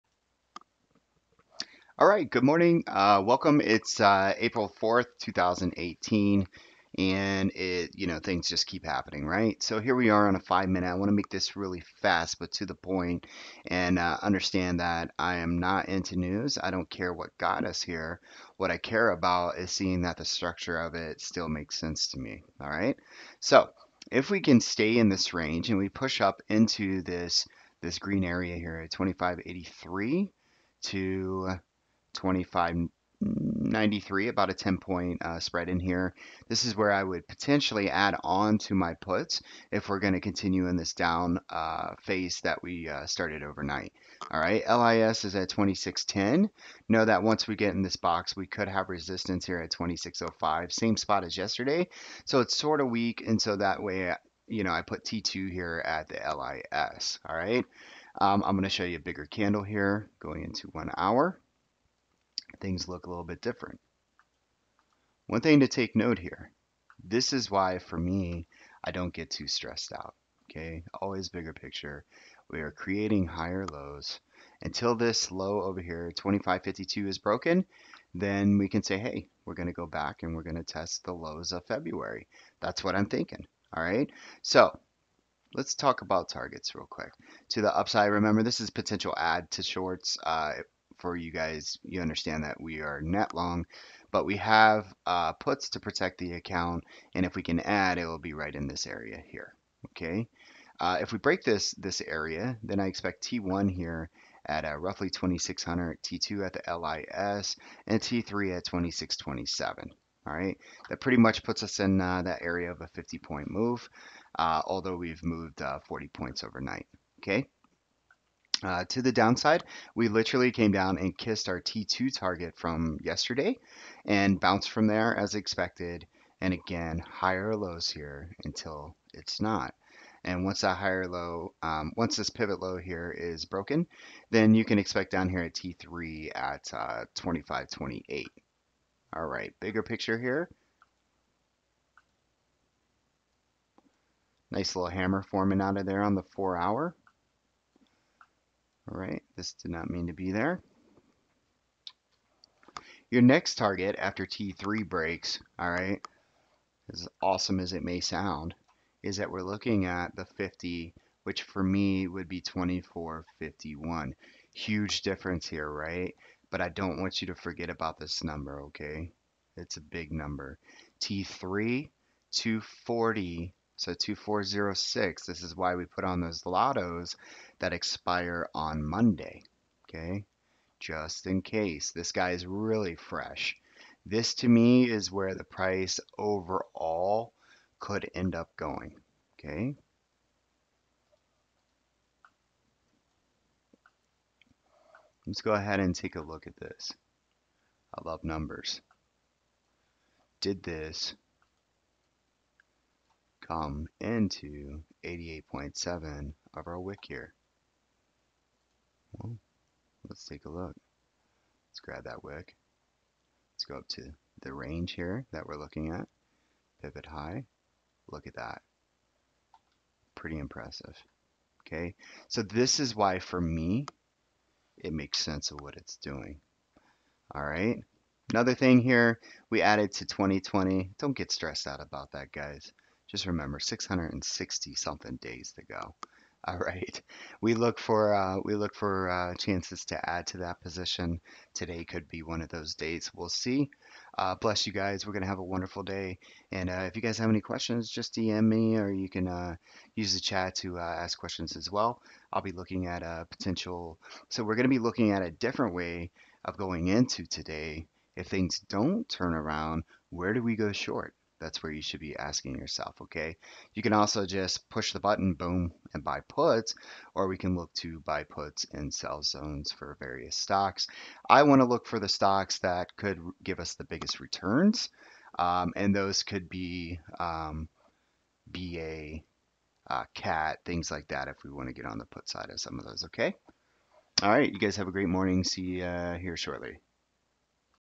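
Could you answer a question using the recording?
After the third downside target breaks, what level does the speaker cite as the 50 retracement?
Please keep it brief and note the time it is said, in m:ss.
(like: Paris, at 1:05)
2451, at 2:42.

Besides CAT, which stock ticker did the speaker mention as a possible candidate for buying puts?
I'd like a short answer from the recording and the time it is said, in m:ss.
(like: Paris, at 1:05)
BA, at 4:38.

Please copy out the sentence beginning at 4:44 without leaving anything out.
All right, you guys have a great morning.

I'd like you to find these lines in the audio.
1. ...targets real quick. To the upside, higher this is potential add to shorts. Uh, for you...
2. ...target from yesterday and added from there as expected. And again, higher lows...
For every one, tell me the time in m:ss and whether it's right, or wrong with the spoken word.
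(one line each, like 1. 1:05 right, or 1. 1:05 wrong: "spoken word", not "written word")
1. 1:26 wrong: "remember", not "higher"
2. 2:02 wrong: "bounced", not "added".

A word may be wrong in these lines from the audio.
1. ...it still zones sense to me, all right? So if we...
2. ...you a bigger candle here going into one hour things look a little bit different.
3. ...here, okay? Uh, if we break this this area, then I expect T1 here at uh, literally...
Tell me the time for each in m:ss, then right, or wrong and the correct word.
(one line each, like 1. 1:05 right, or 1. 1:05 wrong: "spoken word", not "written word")
1. 0:20 wrong: "makes", not "zones"
2. 0:58 right
3. 1:39 wrong: "roughly", not "literally".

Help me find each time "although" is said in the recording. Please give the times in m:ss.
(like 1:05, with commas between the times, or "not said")
1:54.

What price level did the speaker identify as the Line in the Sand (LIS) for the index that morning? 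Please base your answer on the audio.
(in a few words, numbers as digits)
2610.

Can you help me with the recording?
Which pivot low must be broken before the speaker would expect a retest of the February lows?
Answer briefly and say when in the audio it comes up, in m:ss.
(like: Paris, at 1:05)
2552, at 1:16.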